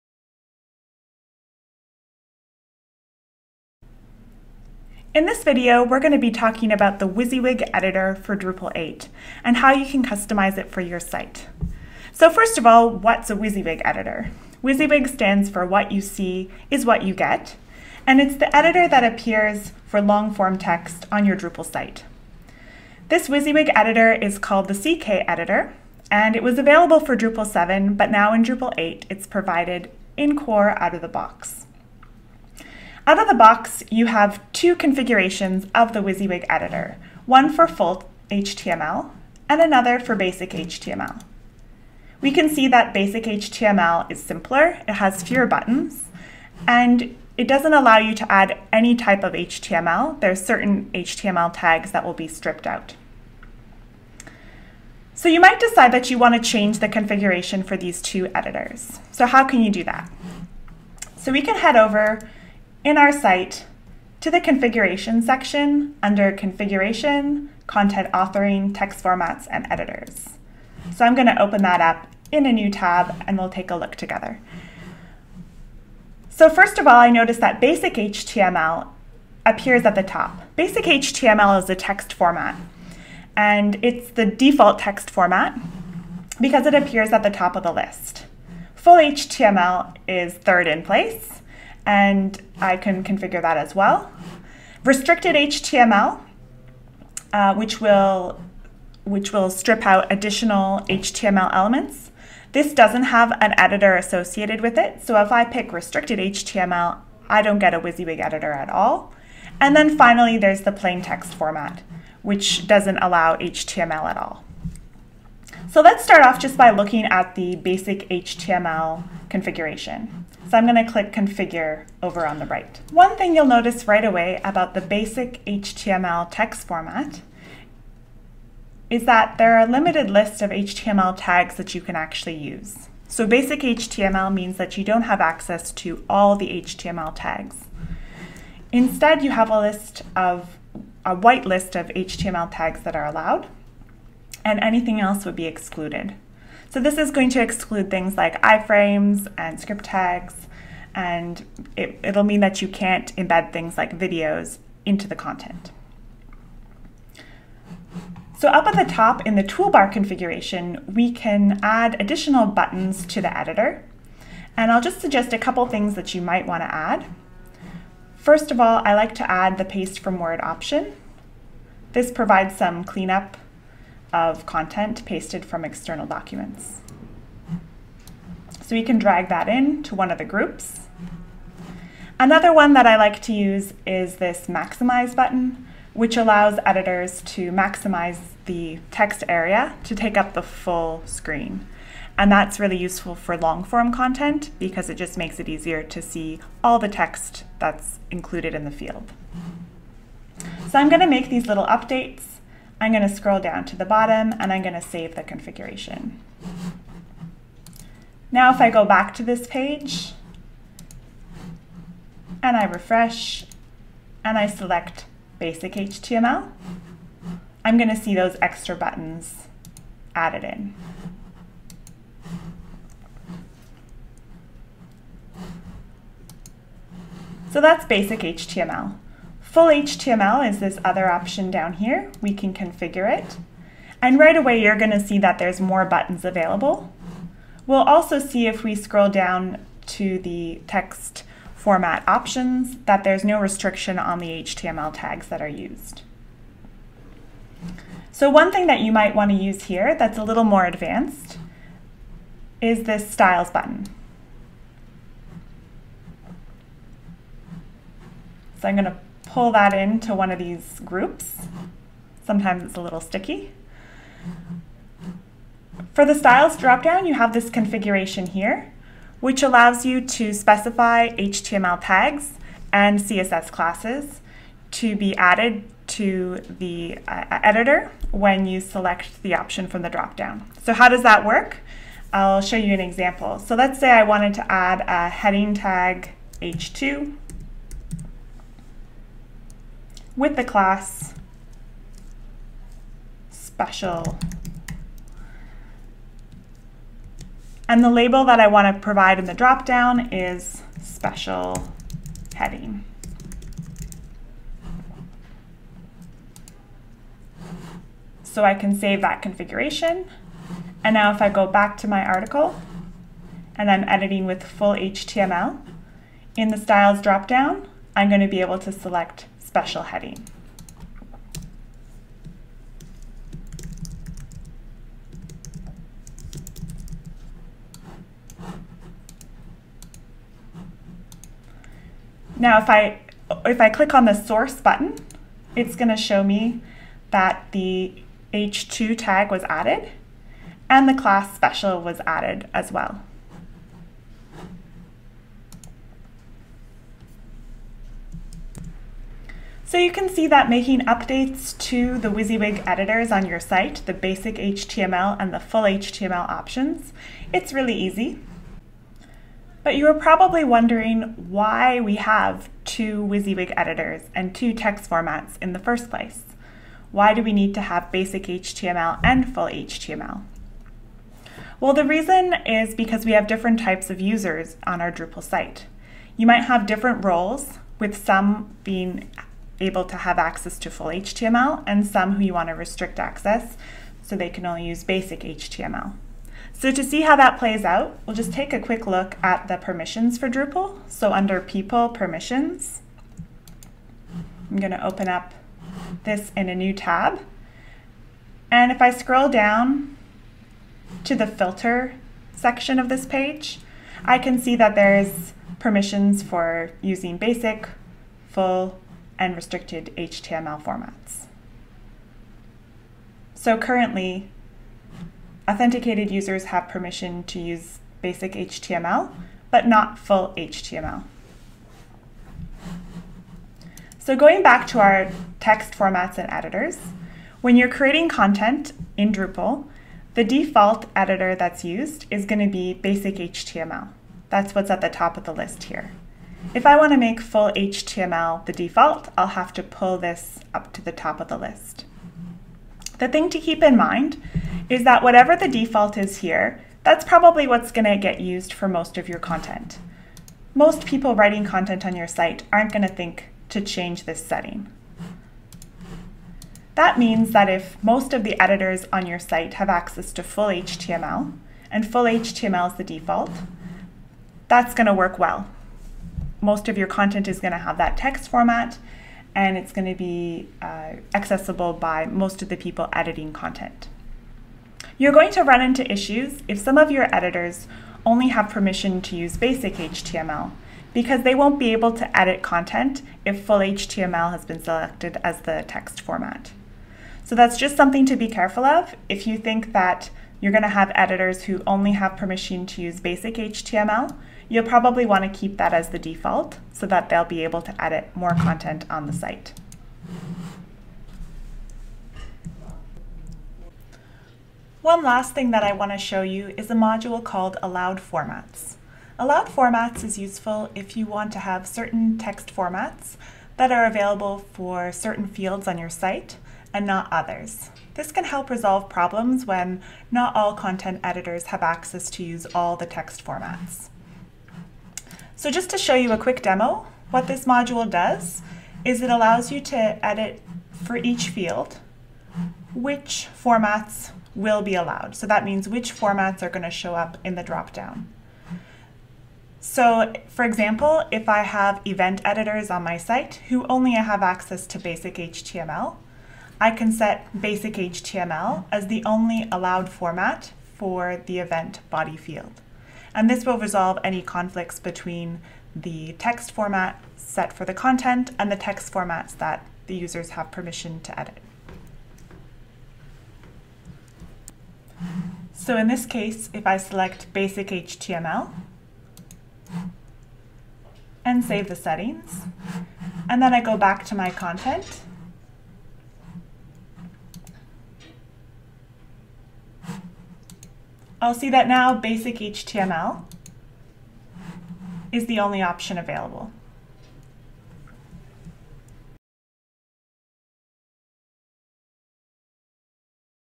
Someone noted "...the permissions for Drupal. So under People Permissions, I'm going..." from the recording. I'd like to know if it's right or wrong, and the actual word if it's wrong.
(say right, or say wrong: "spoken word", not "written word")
right.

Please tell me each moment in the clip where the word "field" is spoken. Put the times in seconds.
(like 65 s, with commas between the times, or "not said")
198 s, 515 s, 531 s, 552 s.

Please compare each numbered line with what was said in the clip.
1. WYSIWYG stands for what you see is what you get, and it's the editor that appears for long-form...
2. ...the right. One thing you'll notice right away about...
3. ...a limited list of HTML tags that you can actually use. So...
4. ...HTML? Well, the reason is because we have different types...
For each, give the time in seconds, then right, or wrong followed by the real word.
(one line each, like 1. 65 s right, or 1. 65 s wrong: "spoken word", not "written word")
1. 14 s right
2. 122 s right
3. 129 s right
4. 369 s right.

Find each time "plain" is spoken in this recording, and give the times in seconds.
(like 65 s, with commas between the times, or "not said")
110 s.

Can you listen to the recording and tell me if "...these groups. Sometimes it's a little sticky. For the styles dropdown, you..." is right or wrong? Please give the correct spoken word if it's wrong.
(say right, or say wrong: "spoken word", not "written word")
right.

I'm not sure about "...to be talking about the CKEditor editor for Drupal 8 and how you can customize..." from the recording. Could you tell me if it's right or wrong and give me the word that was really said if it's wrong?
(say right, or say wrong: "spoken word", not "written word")
wrong: "WYSIWYG", not "CKEditor".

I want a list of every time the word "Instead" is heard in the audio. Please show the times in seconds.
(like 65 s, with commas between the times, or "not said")
138 s.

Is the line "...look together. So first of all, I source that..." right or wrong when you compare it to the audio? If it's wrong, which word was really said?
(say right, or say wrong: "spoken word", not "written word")
wrong: "notice", not "source".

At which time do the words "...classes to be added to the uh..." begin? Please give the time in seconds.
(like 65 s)
273 s.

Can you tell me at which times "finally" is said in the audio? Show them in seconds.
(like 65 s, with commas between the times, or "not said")
109 s.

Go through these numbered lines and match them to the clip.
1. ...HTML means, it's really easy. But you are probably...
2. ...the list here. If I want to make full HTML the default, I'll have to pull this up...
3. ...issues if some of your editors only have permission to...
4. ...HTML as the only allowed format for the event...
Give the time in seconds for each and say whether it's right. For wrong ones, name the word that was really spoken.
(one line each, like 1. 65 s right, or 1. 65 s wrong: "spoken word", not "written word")
1. 355 s wrong: "options", not "means"
2. 435 s right
3. 475 s right
4. 547 s right.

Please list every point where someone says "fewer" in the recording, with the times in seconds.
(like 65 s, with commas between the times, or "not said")
45 s.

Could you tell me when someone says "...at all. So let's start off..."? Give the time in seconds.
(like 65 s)
114 s.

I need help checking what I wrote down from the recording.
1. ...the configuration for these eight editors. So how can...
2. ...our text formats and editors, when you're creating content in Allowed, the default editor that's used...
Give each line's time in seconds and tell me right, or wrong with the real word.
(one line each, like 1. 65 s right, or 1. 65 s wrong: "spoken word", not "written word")
1. 56 s wrong: "two", not "eight"
2. 424 s wrong: "Drupal", not "Allowed".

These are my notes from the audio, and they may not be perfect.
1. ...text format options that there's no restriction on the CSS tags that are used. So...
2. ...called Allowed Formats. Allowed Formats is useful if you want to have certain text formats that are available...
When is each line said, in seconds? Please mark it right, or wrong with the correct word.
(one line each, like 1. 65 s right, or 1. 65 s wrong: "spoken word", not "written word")
1. 240 s wrong: "HTML", not "CSS"
2. 507 s right.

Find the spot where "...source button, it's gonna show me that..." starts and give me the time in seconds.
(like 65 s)
334 s.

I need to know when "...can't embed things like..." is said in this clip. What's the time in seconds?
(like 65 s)
152 s.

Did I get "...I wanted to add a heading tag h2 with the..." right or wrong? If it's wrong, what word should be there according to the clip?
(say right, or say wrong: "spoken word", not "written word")
right.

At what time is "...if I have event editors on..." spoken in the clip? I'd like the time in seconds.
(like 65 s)
541 s.